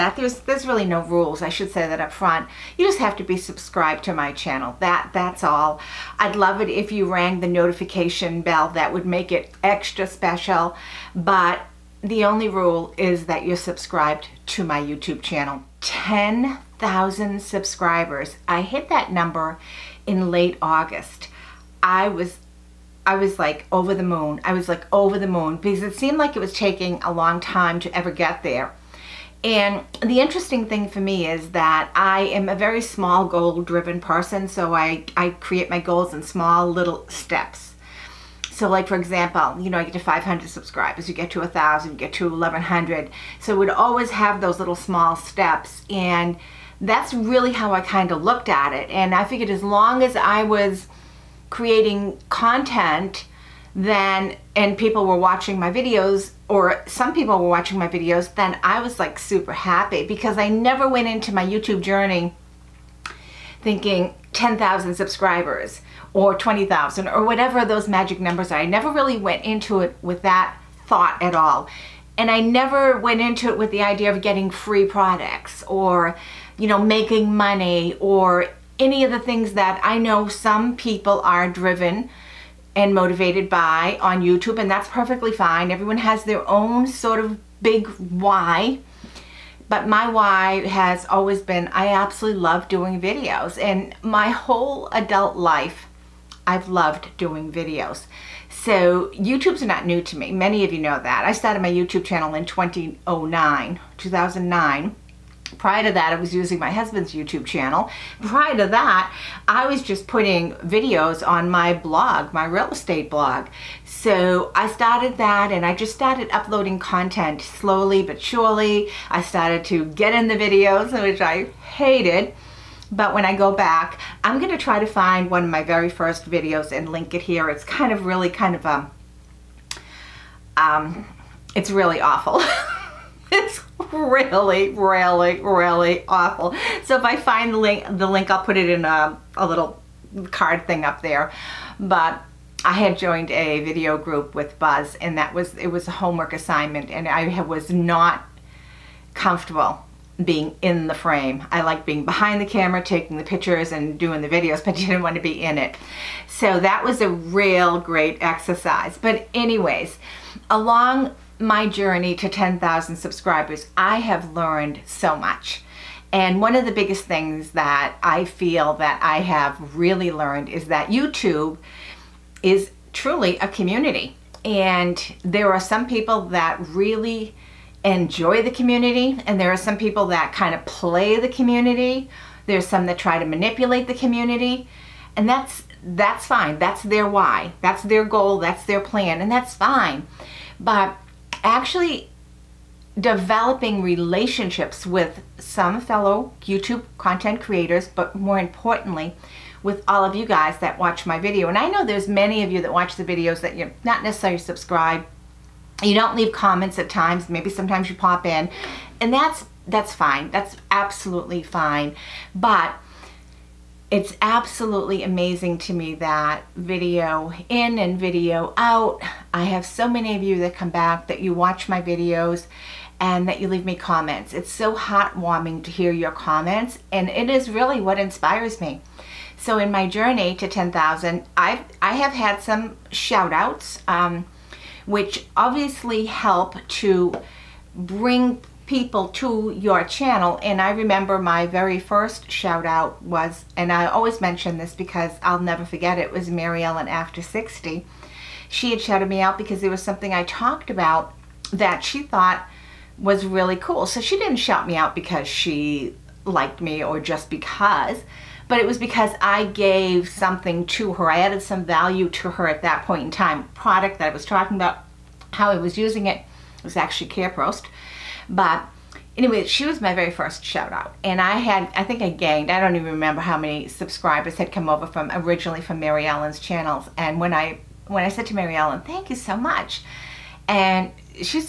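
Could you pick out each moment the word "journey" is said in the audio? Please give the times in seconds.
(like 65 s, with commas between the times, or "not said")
61 s, 161 s, 229 s.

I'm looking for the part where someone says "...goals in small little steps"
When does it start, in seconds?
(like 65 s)
35 s.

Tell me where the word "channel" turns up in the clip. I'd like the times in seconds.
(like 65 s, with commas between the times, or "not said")
4 s, 15 s, 102 s, 107 s, 239 s, 276 s.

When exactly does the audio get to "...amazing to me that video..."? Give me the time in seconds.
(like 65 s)
215 s.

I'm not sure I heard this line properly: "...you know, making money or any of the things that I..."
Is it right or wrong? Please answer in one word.
right.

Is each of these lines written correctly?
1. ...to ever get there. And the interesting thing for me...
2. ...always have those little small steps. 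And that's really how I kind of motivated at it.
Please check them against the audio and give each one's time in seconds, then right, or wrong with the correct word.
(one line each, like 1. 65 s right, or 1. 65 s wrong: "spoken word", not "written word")
1. 27 s right
2. 43 s wrong: "looked", not "motivated".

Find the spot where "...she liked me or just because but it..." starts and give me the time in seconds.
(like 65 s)
255 s.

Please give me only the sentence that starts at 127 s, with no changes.
It's kind of really kind of a, um, um, it's really awful.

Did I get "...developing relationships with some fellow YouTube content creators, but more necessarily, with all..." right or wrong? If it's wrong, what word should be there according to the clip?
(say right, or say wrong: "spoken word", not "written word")
wrong: "importantly", not "necessarily".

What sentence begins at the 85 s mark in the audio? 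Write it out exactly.
Everyone has their own sort of big why.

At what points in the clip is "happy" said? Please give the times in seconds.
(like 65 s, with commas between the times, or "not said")
59 s.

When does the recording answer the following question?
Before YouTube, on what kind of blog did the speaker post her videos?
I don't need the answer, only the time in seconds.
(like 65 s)
112 s.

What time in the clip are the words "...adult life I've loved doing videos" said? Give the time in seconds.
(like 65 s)
94 s.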